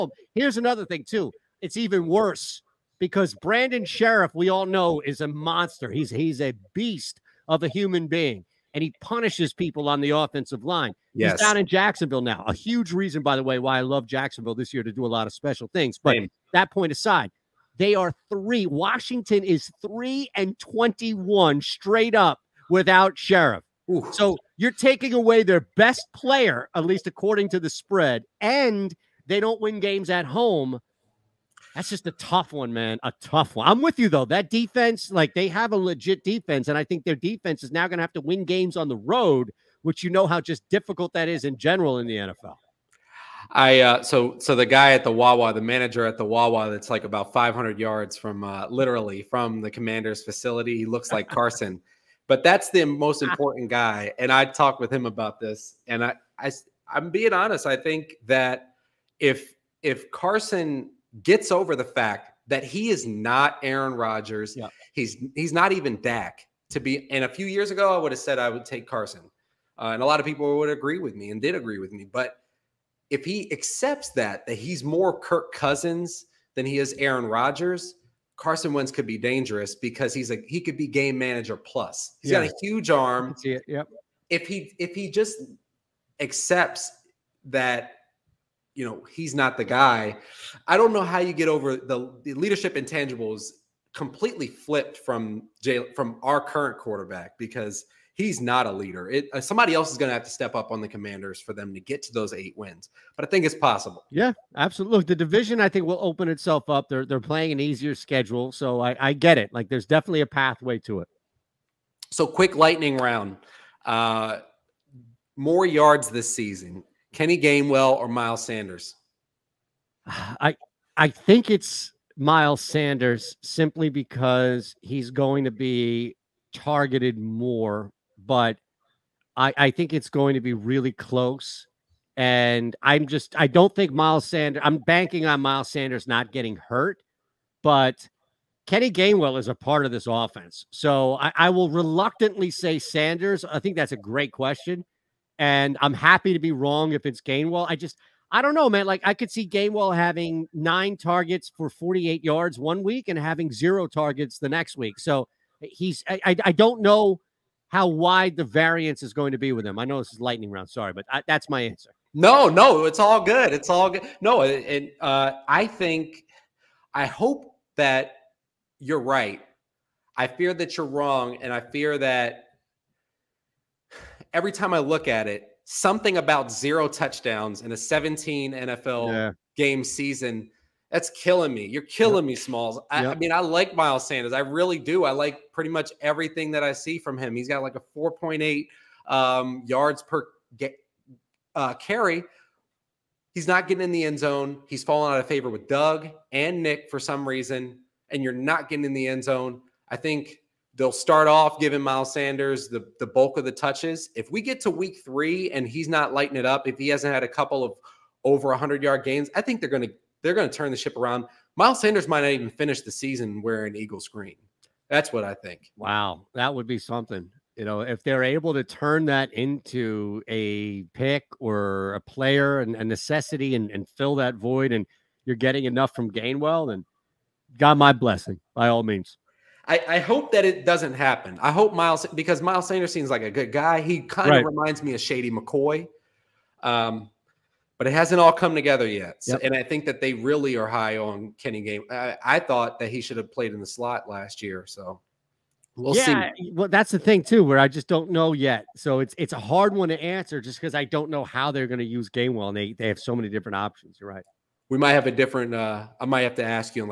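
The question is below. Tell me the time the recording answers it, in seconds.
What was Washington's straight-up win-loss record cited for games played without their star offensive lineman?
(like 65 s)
19 s.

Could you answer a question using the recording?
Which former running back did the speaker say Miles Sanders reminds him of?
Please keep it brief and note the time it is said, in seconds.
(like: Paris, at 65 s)
Shady McCoy, at 235 s.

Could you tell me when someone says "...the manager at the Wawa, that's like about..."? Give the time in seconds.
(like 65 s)
45 s.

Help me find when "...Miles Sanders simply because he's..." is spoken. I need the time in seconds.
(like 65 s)
122 s.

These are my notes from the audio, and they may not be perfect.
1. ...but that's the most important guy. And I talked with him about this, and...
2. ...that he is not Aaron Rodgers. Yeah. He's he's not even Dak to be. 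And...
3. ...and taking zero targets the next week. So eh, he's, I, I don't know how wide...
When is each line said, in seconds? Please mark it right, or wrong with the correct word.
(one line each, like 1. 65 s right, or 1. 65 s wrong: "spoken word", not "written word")
1. 52 s right
2. 62 s right
3. 153 s wrong: "having", not "taking".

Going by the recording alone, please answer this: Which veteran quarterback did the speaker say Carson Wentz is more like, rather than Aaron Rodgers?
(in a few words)
Kirk Cousins.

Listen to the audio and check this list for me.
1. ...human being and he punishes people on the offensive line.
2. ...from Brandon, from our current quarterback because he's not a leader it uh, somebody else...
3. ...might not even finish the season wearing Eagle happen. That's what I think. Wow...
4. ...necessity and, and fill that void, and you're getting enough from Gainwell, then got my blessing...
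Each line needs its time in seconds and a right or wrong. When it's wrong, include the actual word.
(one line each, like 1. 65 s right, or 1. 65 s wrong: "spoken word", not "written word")
1. 7 s right
2. 94 s wrong: "Jay", not "Brandon"
3. 212 s wrong: "screen", not "happen"
4. 222 s right.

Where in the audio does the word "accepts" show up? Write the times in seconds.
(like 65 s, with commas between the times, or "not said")
73 s, 86 s.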